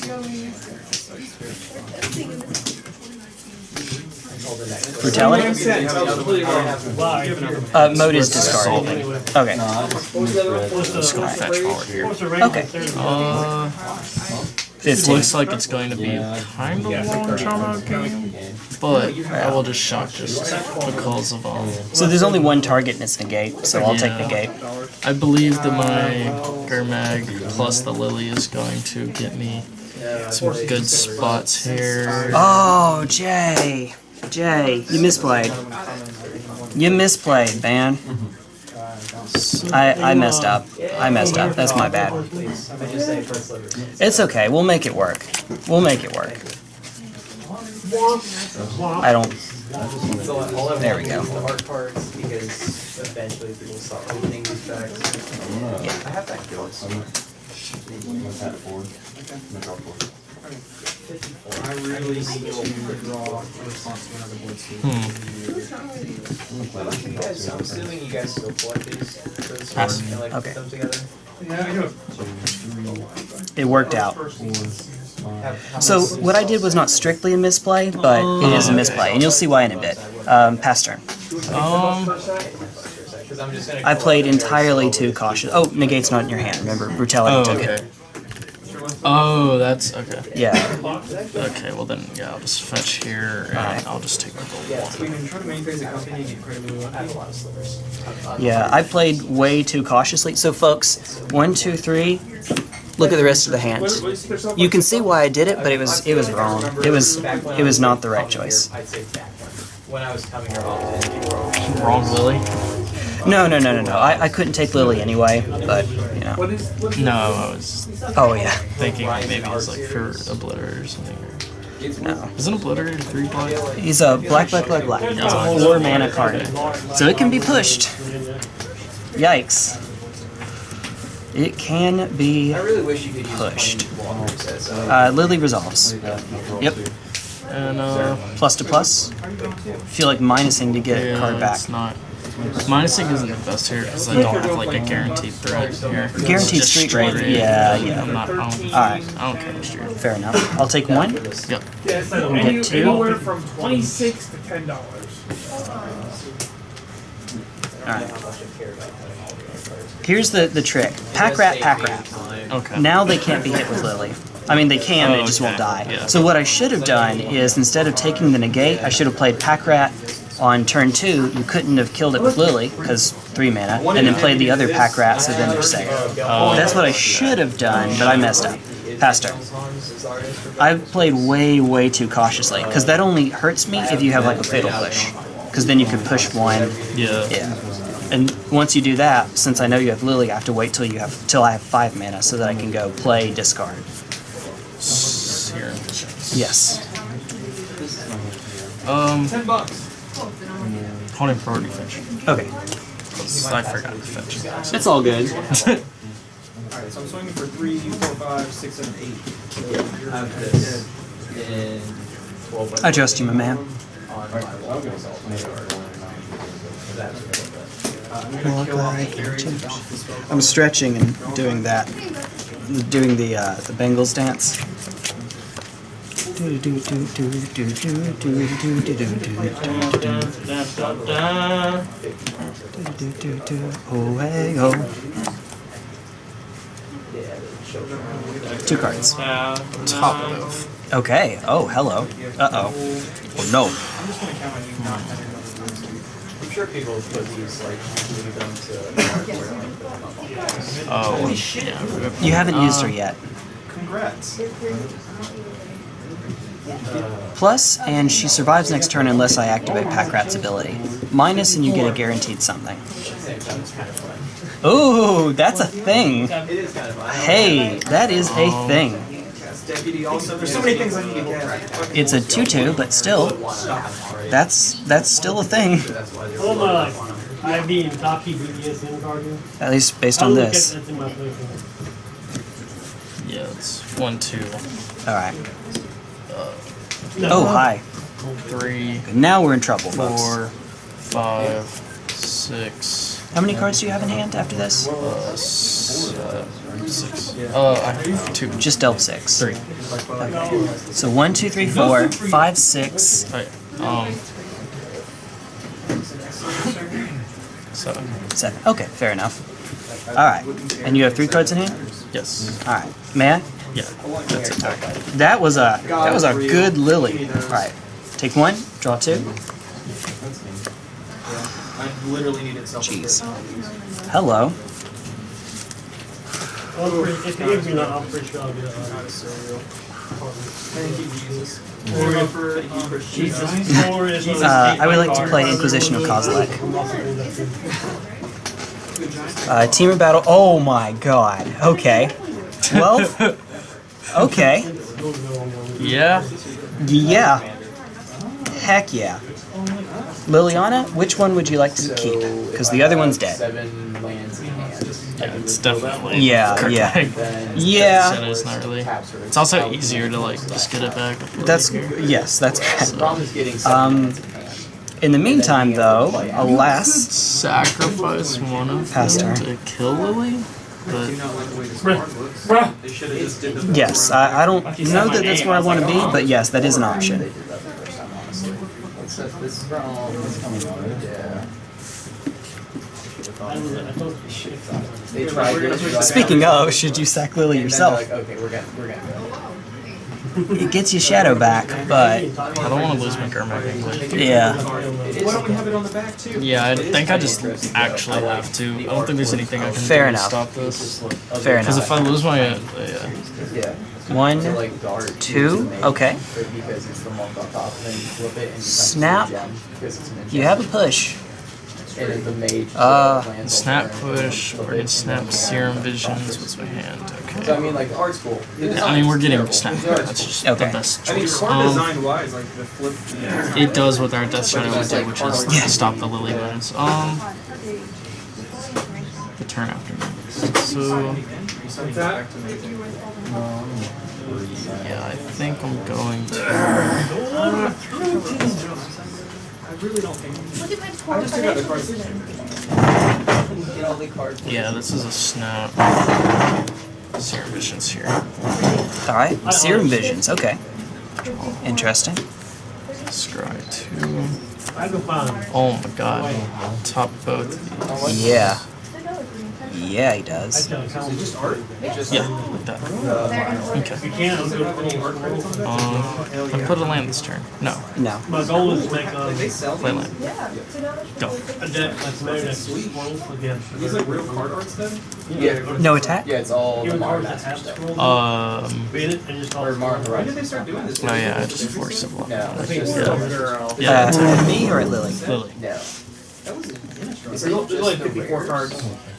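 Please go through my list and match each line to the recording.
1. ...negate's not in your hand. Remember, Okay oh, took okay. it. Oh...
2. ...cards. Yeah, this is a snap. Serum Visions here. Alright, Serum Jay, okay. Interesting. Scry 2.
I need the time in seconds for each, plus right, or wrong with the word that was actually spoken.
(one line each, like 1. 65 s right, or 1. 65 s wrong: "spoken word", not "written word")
1. 85 s wrong: "Brutality", not "Okay"
2. 444 s wrong: "Visions", not "Jay".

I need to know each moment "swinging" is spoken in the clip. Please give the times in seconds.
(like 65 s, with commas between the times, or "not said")
207 s.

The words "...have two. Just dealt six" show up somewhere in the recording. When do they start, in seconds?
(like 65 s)
297 s.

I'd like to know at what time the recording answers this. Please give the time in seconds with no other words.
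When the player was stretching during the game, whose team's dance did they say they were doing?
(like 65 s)
223 s.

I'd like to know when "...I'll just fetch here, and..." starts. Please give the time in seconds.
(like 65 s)
92 s.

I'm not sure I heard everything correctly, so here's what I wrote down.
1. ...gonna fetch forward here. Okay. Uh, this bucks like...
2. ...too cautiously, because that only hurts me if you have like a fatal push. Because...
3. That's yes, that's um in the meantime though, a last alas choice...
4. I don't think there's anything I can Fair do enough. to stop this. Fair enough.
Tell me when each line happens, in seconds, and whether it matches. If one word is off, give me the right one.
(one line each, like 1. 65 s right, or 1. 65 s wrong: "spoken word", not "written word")
1. 11 s wrong: "looks", not "bucks"
2. 181 s right
3. 361 s wrong: "sacrifice", not "choice"
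4. 398 s right.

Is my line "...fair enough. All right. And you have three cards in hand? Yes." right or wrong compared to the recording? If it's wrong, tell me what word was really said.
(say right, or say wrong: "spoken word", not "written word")
right.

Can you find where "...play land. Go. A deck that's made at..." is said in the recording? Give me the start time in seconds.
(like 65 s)
469 s.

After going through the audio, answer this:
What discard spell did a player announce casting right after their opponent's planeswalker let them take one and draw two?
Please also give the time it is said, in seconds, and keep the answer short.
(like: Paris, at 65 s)
Inquisition of Kozilek, at 335 s.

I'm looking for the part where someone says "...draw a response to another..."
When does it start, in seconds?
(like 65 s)
63 s.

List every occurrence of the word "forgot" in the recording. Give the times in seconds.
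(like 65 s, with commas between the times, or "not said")
203 s.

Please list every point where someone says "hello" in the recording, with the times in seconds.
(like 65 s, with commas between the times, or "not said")
241 s, 324 s.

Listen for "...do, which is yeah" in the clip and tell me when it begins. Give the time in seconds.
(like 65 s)
424 s.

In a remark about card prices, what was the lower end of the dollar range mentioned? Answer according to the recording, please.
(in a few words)
$10.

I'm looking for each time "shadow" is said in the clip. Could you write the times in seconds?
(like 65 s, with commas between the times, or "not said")
391 s, 424 s.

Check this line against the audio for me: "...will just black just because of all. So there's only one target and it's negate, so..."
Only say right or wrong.
wrong.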